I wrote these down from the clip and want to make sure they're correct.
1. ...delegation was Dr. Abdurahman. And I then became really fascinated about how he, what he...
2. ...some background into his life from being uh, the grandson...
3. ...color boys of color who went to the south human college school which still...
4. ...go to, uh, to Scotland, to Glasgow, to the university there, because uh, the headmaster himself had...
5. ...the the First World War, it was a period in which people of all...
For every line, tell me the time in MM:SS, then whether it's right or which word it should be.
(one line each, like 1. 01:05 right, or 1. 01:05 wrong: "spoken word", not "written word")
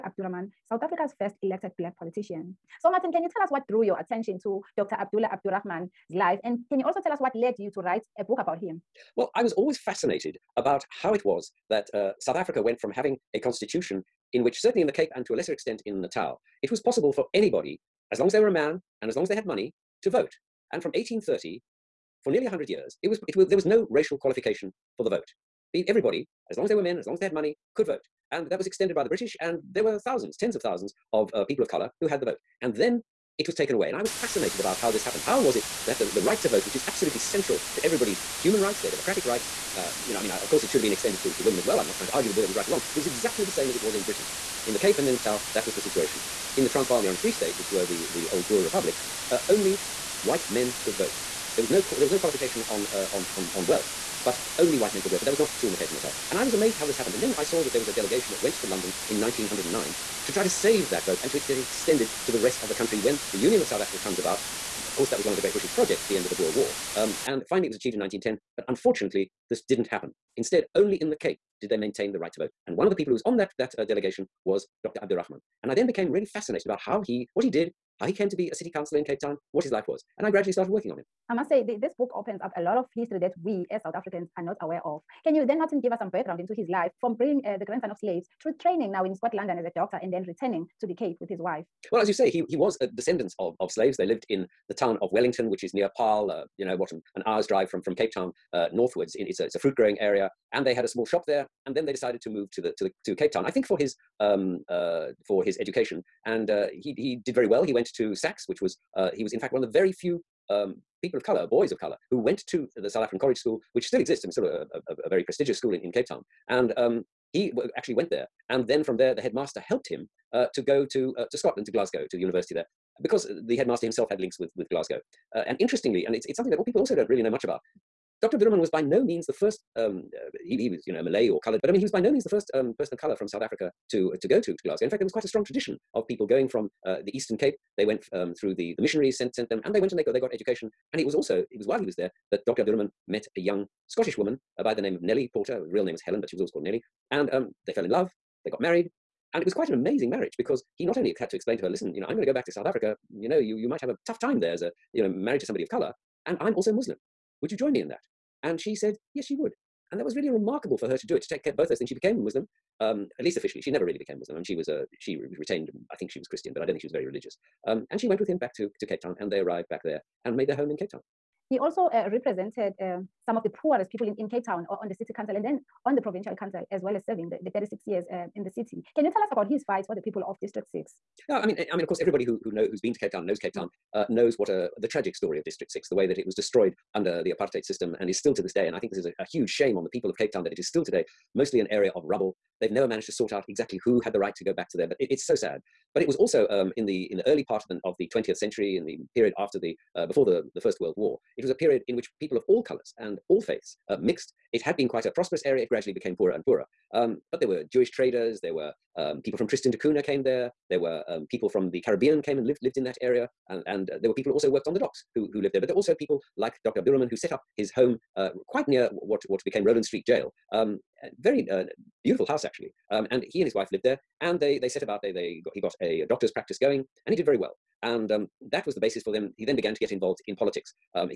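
1. 01:13 right
2. 01:25 right
3. 01:51 wrong: "african", not "human"
4. 02:00 right
5. 03:20 right.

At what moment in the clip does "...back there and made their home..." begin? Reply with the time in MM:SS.
02:49.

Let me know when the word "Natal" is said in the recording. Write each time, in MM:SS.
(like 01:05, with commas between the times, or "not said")
00:16, 00:45, 00:55.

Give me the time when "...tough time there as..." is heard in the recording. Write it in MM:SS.
02:34.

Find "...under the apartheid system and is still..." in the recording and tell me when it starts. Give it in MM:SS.
03:06.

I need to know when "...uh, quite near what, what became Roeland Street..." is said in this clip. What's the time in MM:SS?
03:38.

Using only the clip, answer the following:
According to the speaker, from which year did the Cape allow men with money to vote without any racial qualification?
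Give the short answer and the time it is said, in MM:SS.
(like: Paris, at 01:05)
1830, at 00:20.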